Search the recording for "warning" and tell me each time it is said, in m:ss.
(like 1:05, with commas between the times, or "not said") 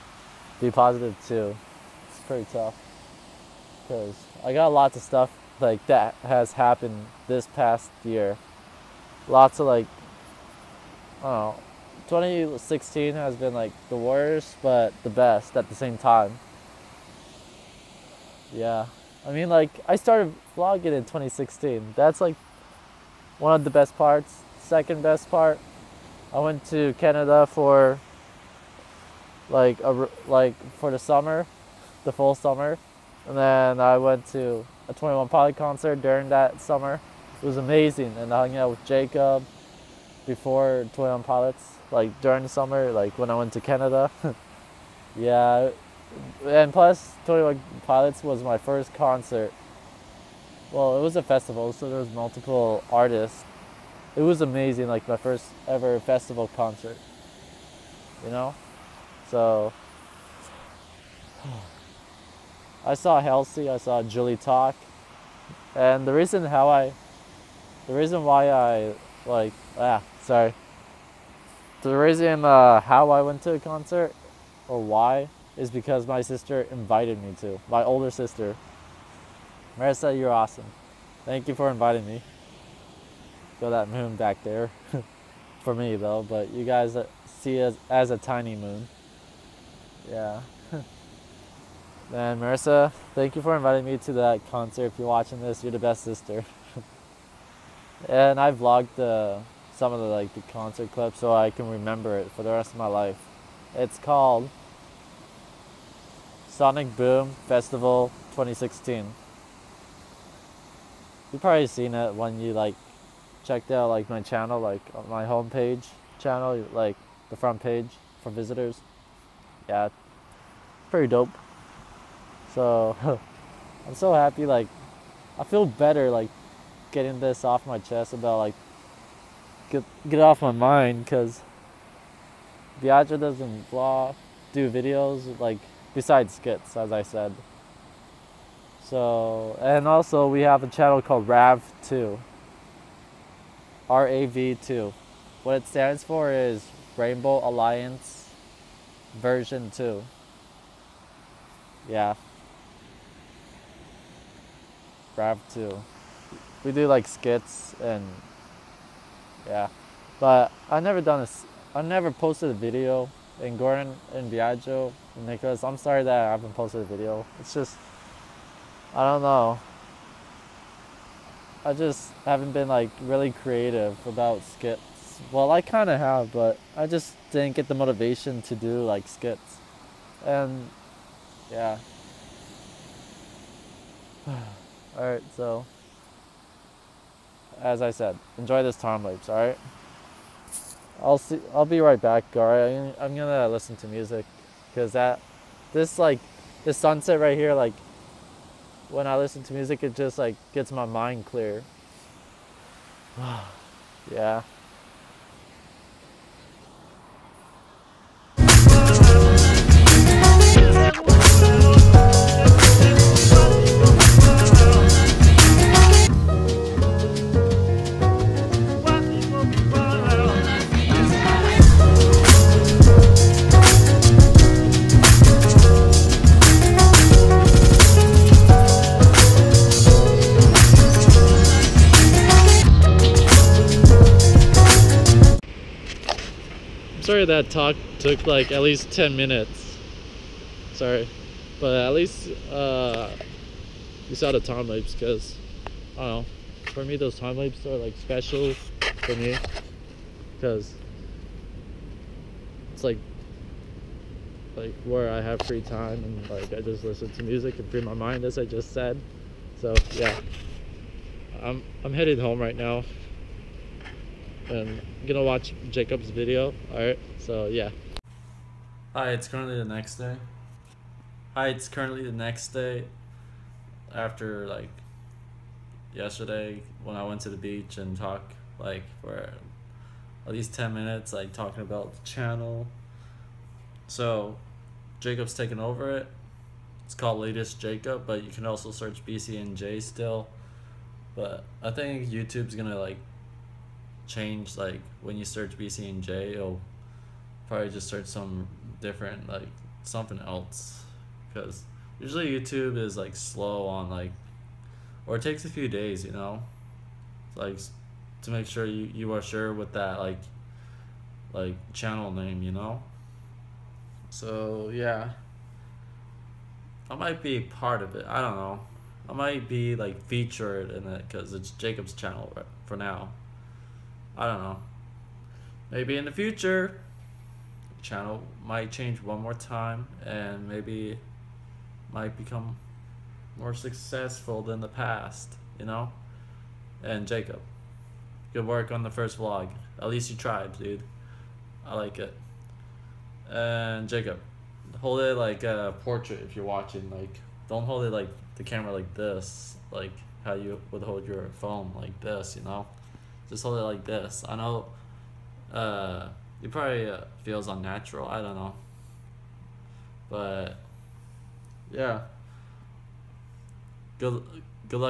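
not said.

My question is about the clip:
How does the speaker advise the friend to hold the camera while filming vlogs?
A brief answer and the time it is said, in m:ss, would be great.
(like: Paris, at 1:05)
like a portrait, at 5:45.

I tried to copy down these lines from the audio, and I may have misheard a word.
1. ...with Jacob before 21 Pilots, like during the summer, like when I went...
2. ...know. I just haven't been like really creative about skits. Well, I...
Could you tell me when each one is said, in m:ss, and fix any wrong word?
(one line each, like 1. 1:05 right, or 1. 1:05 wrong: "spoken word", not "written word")
1. 0:38 right
2. 2:49 right.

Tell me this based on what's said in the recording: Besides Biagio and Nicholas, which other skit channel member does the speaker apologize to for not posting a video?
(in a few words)
Gordon.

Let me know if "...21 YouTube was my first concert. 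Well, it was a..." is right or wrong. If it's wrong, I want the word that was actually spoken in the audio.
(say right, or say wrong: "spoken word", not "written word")
wrong: "Pilots", not "YouTube".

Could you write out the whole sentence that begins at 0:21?
That's like one of the best parts.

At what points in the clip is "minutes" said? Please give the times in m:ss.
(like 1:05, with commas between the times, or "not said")
3:59, 4:40.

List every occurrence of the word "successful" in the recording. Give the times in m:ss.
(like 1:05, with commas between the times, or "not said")
5:33.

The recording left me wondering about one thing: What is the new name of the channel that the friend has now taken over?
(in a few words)
Latest Jacob.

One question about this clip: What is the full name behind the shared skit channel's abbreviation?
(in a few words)
Rainbow Alliance Version Two.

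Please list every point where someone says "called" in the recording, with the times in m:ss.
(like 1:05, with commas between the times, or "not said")
1:43, 2:21, 4:46.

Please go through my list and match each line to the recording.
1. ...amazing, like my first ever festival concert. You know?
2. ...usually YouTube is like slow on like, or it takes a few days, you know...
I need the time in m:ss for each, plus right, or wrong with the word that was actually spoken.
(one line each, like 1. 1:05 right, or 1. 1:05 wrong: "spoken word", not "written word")
1. 0:54 right
2. 5:01 right.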